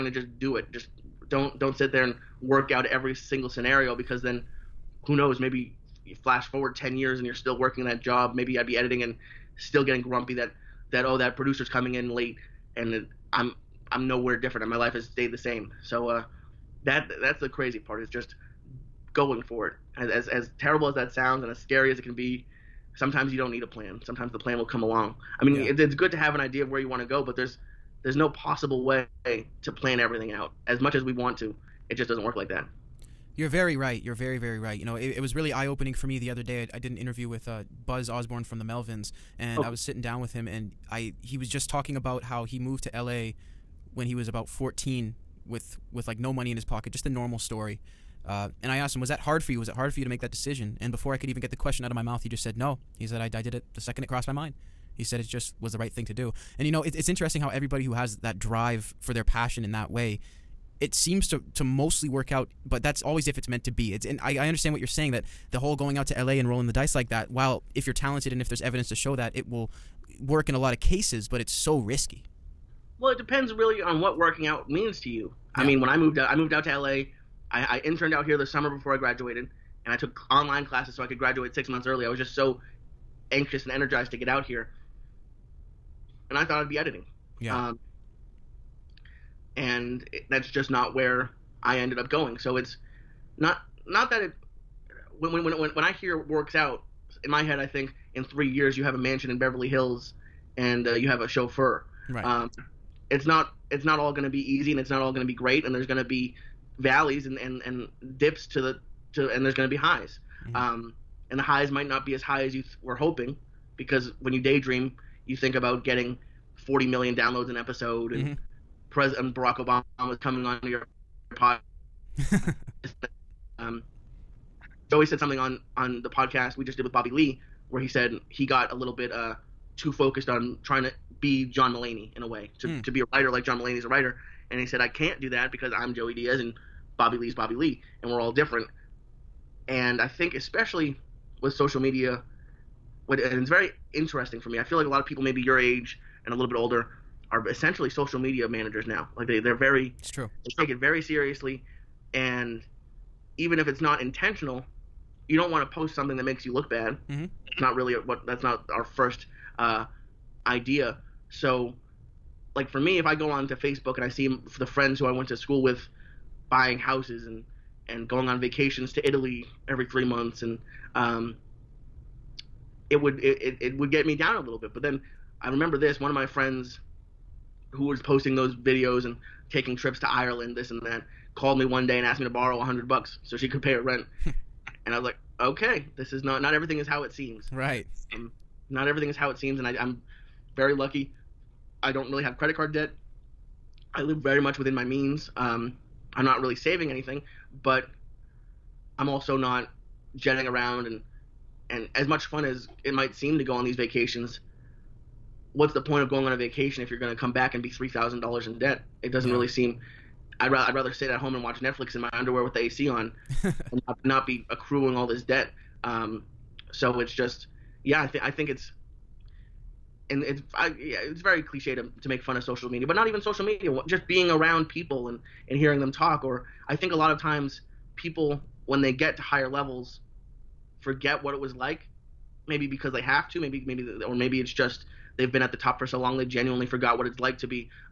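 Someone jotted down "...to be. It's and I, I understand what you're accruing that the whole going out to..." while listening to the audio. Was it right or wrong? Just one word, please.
wrong.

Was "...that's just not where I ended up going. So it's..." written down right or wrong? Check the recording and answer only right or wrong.
right.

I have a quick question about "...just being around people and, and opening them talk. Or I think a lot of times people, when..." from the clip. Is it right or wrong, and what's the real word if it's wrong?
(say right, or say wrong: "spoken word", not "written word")
wrong: "hearing", not "opening".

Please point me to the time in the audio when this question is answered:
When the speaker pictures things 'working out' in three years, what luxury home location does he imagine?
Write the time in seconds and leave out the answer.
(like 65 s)
99 s.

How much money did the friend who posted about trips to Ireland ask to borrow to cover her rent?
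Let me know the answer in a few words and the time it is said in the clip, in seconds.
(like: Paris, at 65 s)
$100, at 182 s.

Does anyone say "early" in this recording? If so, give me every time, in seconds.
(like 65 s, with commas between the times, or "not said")
81 s.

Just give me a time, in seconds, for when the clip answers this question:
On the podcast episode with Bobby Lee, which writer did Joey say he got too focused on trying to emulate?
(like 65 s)
131 s.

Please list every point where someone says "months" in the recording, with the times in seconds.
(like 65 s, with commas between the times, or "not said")
81 s, 170 s.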